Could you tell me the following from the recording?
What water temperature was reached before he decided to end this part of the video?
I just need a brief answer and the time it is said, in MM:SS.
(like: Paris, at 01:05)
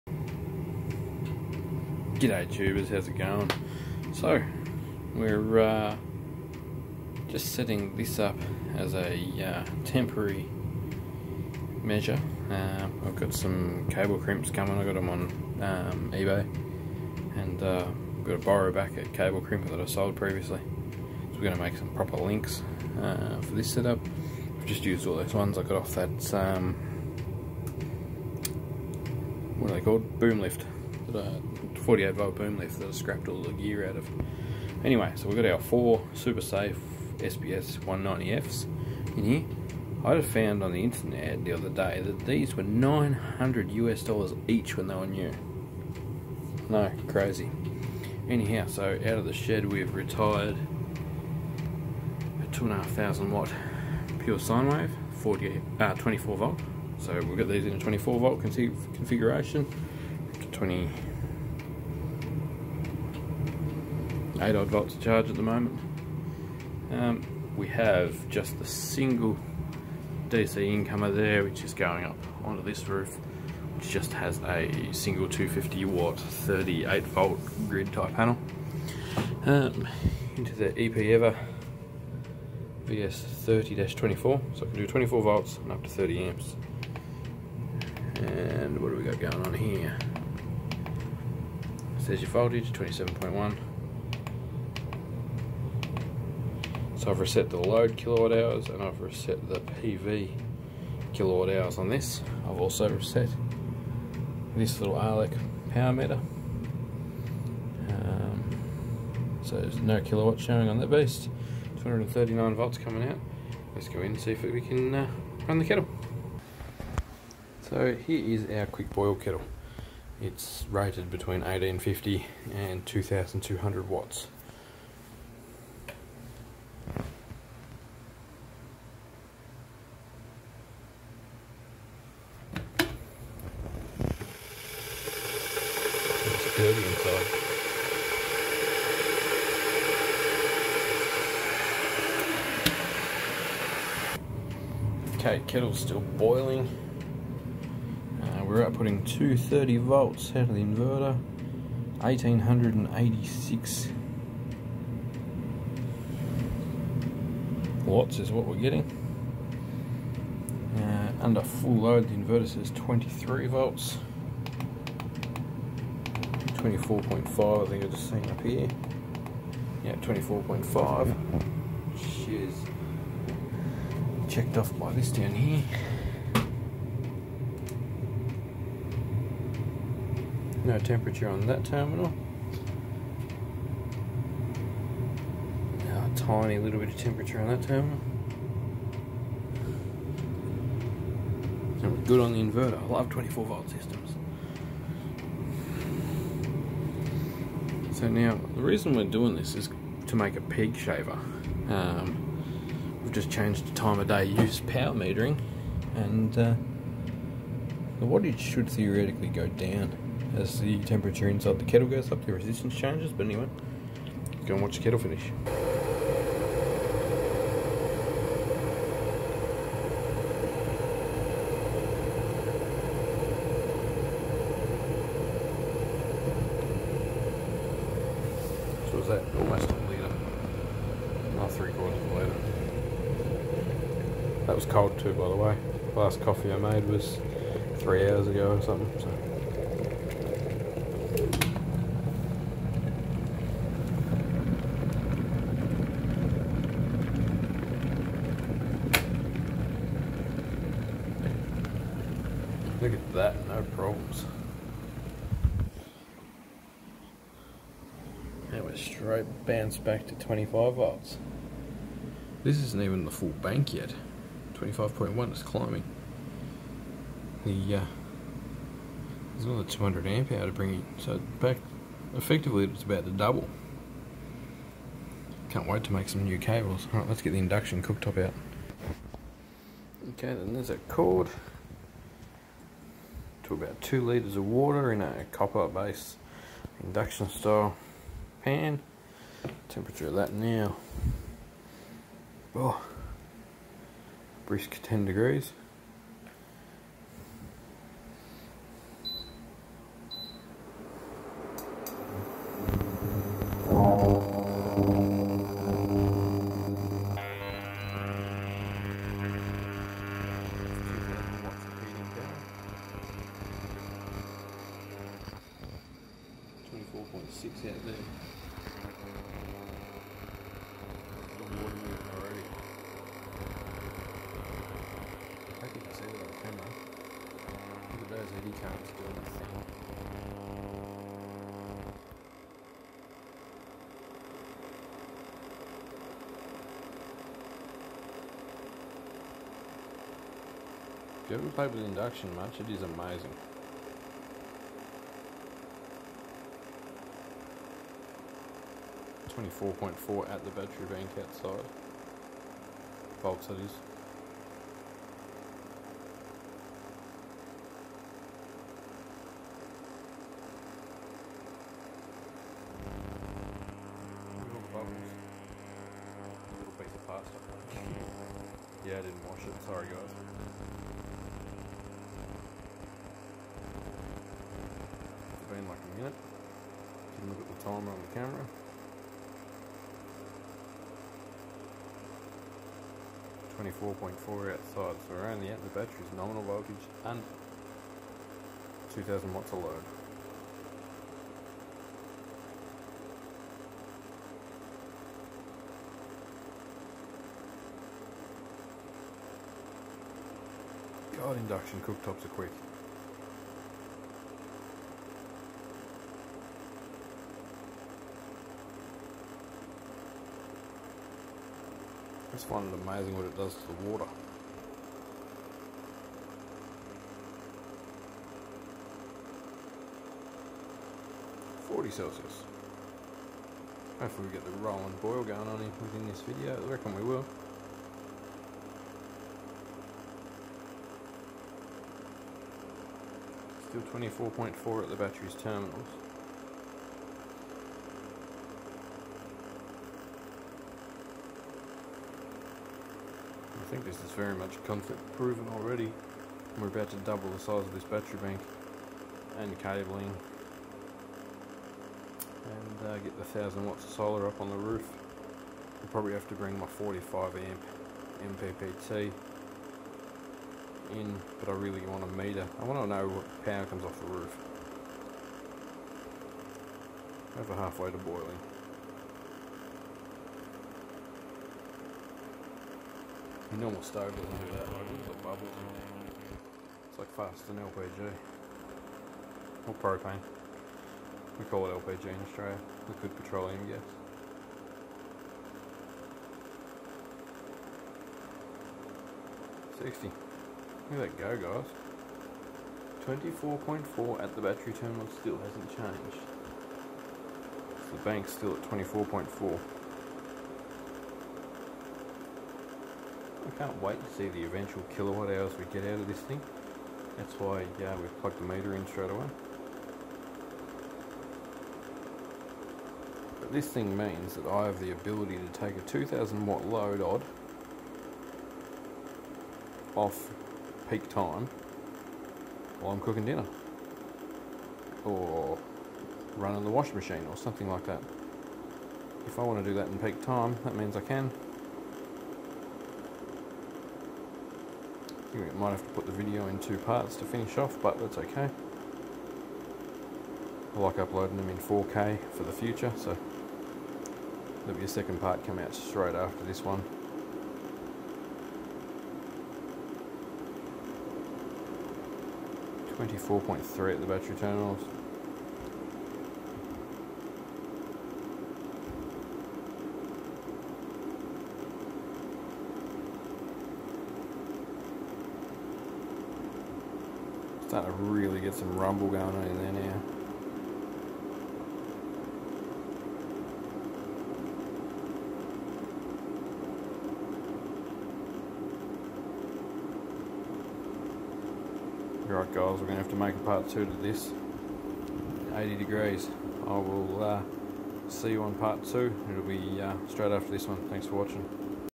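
80 degrees, at 09:45.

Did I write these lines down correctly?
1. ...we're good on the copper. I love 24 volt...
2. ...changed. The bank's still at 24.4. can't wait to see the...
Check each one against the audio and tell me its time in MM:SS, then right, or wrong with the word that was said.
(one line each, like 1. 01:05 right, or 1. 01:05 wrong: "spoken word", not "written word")
1. 03:11 wrong: "inverter", not "copper"
2. 08:15 right.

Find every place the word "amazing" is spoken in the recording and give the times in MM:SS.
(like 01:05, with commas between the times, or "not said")
05:42, 06:52.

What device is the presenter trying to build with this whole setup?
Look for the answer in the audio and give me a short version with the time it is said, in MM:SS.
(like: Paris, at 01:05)
peak shaver, at 03:20.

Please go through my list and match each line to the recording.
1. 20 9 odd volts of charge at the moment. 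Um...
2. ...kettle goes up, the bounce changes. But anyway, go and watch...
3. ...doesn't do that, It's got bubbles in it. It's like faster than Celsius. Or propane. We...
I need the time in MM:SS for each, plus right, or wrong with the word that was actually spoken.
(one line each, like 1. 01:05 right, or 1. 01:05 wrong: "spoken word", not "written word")
1. 01:00 wrong: "8", not "9"
2. 03:31 wrong: "resistance", not "bounce"
3. 07:54 wrong: "LPG", not "Celsius".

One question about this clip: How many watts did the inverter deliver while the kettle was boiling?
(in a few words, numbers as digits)
1886 watts.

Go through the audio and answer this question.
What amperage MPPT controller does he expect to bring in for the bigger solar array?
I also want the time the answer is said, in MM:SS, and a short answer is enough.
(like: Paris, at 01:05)
45 amp, at 07:36.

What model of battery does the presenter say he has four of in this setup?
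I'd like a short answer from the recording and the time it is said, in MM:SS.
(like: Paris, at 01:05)
SBS 190F, at 00:37.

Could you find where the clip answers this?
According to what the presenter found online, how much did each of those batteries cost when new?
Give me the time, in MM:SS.
00:42.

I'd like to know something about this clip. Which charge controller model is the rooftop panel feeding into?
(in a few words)
EPEver VS30-24.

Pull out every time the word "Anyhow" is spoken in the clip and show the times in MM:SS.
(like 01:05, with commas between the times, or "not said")
00:48.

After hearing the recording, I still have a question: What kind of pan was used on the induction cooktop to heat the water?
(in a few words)
copper base induction style pan.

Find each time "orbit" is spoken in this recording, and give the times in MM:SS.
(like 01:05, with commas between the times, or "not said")
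not said.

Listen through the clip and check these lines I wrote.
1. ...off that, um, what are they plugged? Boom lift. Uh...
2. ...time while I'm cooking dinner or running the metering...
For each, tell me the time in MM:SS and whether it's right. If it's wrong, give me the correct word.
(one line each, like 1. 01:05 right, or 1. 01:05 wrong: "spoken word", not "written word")
1. 00:25 wrong: "called", not "plugged"
2. 08:41 wrong: "washing", not "metering".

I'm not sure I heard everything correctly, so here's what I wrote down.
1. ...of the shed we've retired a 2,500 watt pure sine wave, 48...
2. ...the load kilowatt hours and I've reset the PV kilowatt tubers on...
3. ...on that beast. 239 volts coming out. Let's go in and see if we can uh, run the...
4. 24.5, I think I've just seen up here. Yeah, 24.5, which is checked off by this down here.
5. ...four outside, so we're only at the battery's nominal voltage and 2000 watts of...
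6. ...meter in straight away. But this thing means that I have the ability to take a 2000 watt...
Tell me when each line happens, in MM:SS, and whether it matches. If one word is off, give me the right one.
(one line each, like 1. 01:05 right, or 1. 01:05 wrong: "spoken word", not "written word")
1. 00:49 right
2. 01:37 wrong: "hours", not "tubers"
3. 01:50 right
4. 02:46 right
5. 06:24 right
6. 08:28 right.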